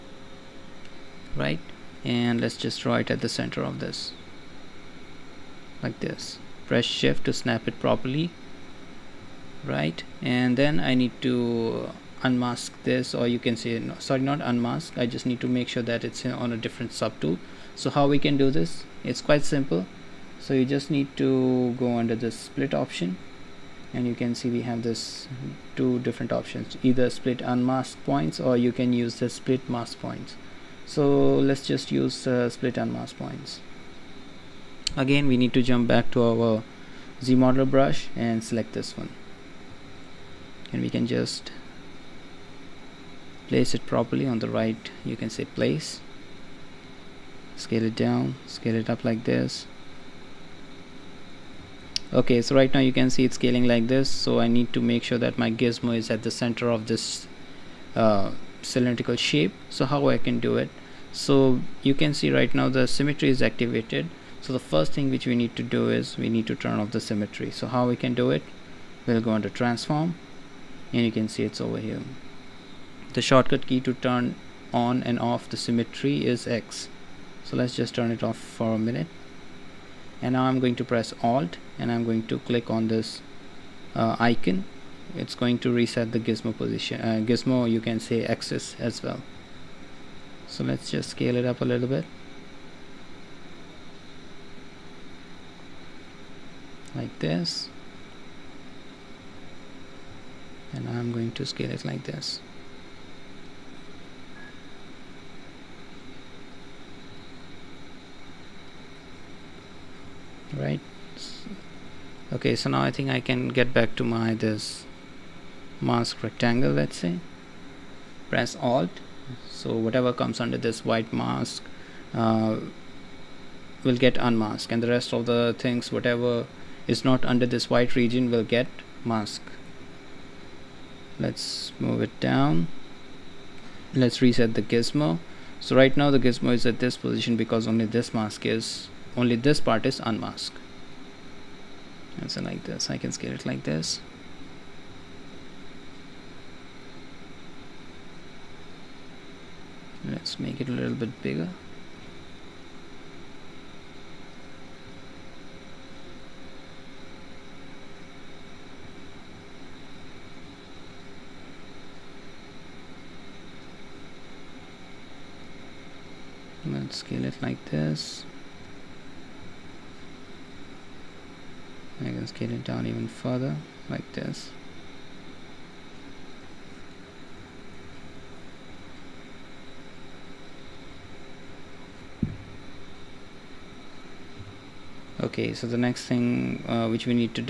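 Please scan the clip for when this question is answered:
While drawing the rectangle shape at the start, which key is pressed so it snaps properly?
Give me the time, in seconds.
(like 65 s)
6 s.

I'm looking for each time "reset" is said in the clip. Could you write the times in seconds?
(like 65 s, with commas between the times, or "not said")
85 s, 134 s.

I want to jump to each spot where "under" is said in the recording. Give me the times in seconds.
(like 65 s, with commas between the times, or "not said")
21 s, 120 s, 127 s.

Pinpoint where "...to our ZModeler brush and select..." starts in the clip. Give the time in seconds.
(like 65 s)
36 s.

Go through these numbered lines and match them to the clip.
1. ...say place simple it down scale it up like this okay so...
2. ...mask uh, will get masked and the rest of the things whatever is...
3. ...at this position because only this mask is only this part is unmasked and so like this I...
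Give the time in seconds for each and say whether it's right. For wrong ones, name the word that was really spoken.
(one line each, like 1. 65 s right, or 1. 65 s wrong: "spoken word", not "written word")
1. 45 s wrong: "scale", not "simple"
2. 121 s wrong: "unmasked", not "masked"
3. 136 s right.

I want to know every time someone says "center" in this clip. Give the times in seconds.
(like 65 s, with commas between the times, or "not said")
3 s, 56 s.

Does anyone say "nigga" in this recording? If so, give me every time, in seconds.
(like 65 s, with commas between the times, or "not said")
not said.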